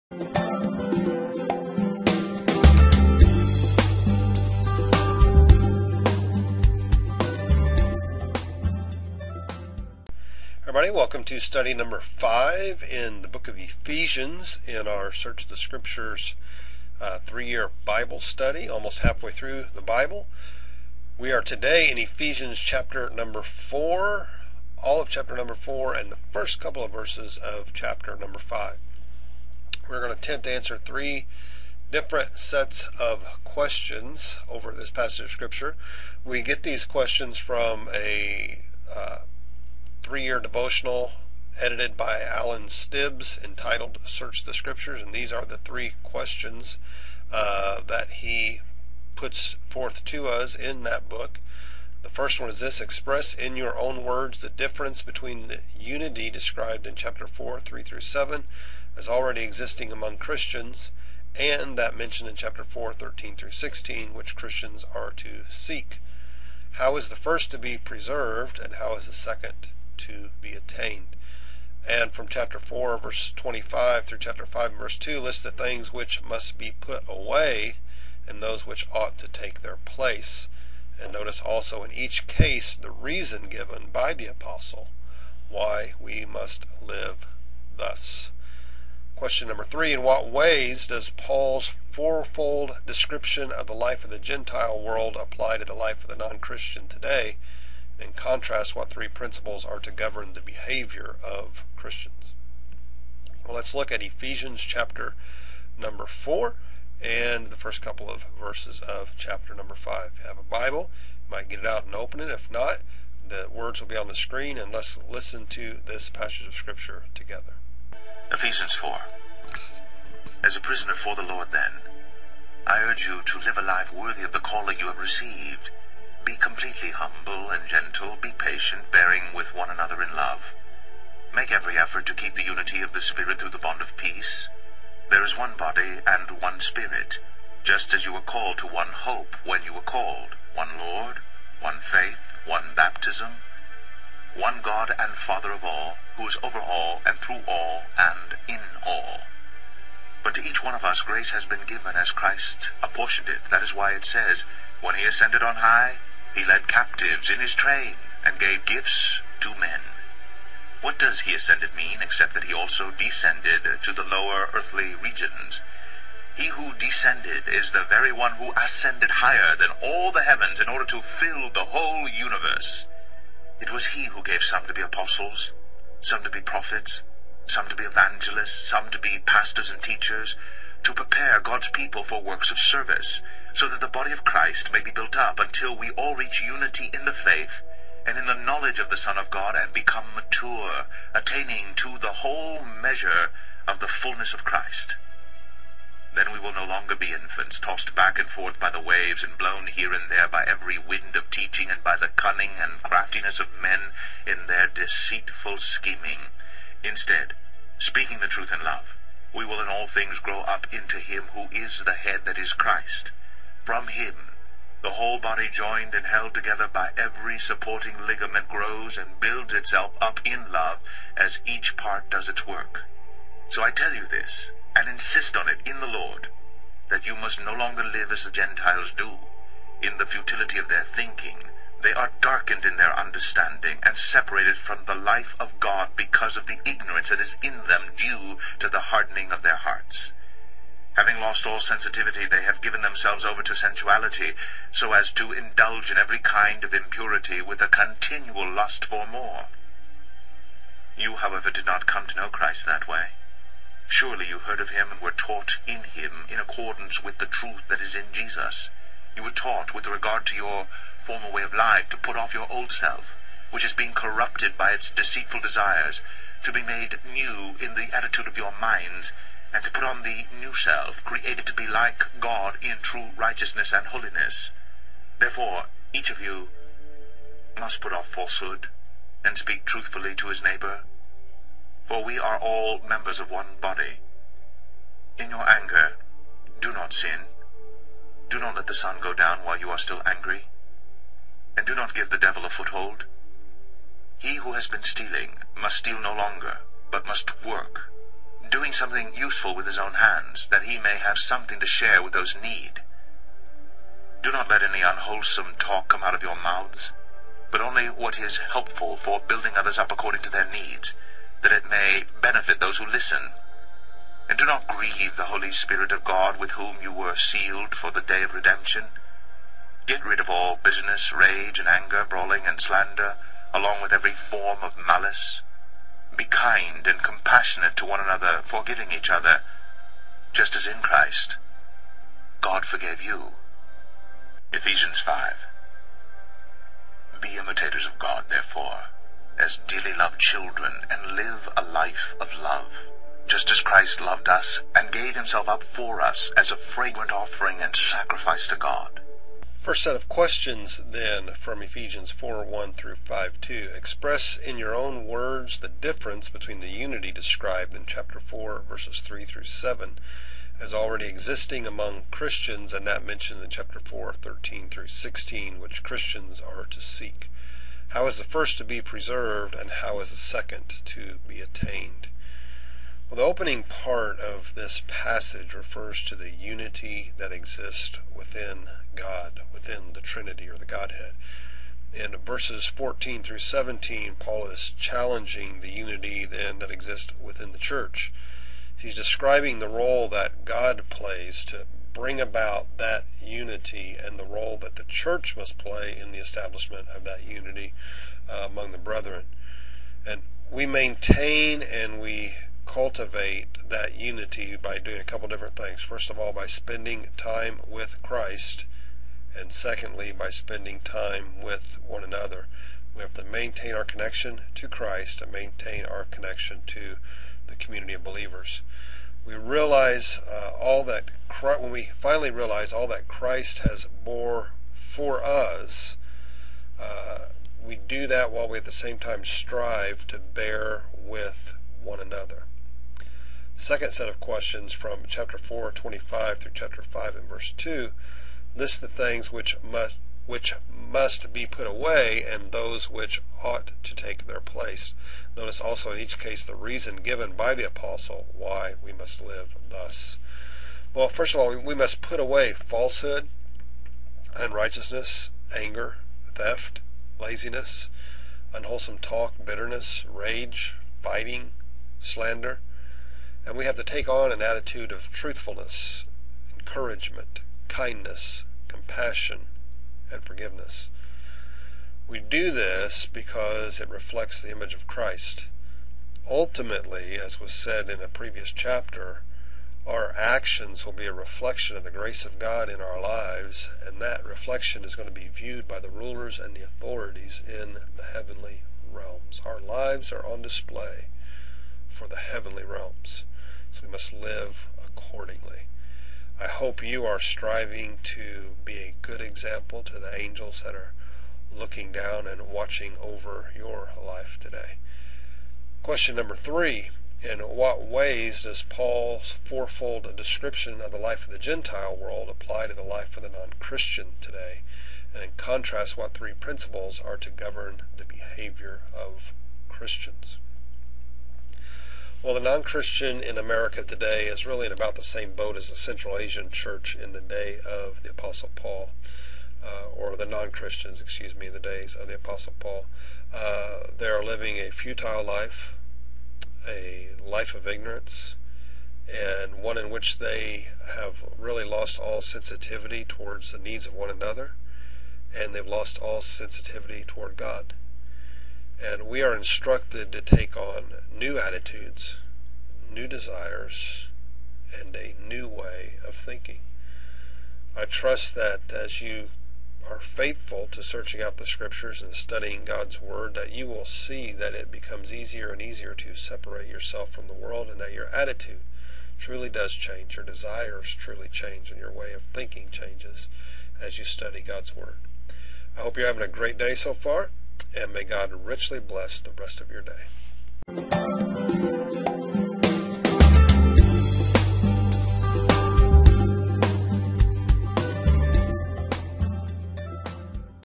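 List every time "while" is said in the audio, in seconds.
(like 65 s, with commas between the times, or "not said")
289 s, 428 s.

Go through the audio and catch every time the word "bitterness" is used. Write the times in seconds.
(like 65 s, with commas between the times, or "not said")
320 s, 459 s.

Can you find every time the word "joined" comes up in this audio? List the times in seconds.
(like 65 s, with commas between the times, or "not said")
215 s.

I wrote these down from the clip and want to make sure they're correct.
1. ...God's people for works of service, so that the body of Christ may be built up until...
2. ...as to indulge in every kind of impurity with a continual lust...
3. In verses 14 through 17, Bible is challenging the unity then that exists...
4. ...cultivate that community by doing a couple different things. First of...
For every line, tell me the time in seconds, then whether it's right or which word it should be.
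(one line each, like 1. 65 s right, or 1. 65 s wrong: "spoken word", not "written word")
1. 181 s right
2. 244 s right
3. 381 s wrong: "Paul", not "Bible"
4. 402 s wrong: "unity", not "community".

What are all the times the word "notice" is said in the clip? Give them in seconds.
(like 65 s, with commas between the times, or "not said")
81 s, 445 s.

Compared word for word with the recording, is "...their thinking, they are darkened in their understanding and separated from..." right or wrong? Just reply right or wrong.
right.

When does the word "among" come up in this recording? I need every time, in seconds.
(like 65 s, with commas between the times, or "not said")
59 s, 361 s, 398 s.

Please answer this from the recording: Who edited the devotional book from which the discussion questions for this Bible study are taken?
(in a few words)
Alan Stibbs.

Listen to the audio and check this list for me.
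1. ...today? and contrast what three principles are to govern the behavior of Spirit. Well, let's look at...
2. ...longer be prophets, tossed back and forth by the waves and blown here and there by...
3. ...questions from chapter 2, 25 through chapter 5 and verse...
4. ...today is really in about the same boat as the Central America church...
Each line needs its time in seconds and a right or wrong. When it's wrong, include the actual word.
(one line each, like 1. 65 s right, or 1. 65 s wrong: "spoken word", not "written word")
1. 96 s wrong: "Christians", not "Spirit"
2. 196 s wrong: "infants", not "prophets"
3. 434 s wrong: "4", not "2"
4. 523 s wrong: "Asian", not "America".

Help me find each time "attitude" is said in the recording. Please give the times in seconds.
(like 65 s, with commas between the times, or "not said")
267 s, 464 s, 551 s, 568 s.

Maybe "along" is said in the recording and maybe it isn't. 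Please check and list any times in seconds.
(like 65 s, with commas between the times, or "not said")
323 s.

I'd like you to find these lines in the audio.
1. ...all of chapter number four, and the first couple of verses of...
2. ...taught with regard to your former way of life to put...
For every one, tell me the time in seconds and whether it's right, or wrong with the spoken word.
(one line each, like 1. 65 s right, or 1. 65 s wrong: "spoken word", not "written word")
1. 24 s right
2. 259 s right.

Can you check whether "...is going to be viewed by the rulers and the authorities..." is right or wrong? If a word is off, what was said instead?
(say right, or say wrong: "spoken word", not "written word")
right.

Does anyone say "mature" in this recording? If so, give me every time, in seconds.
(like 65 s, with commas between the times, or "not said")
190 s.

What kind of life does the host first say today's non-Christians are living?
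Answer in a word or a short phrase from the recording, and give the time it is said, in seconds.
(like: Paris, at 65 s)
futile life, at 534 s.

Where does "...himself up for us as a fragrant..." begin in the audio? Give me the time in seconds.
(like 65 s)
345 s.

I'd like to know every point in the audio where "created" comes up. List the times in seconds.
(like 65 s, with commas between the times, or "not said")
271 s.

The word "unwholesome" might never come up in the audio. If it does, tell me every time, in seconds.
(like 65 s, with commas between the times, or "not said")
304 s, 458 s.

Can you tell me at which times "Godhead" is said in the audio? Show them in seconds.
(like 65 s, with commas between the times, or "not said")
380 s.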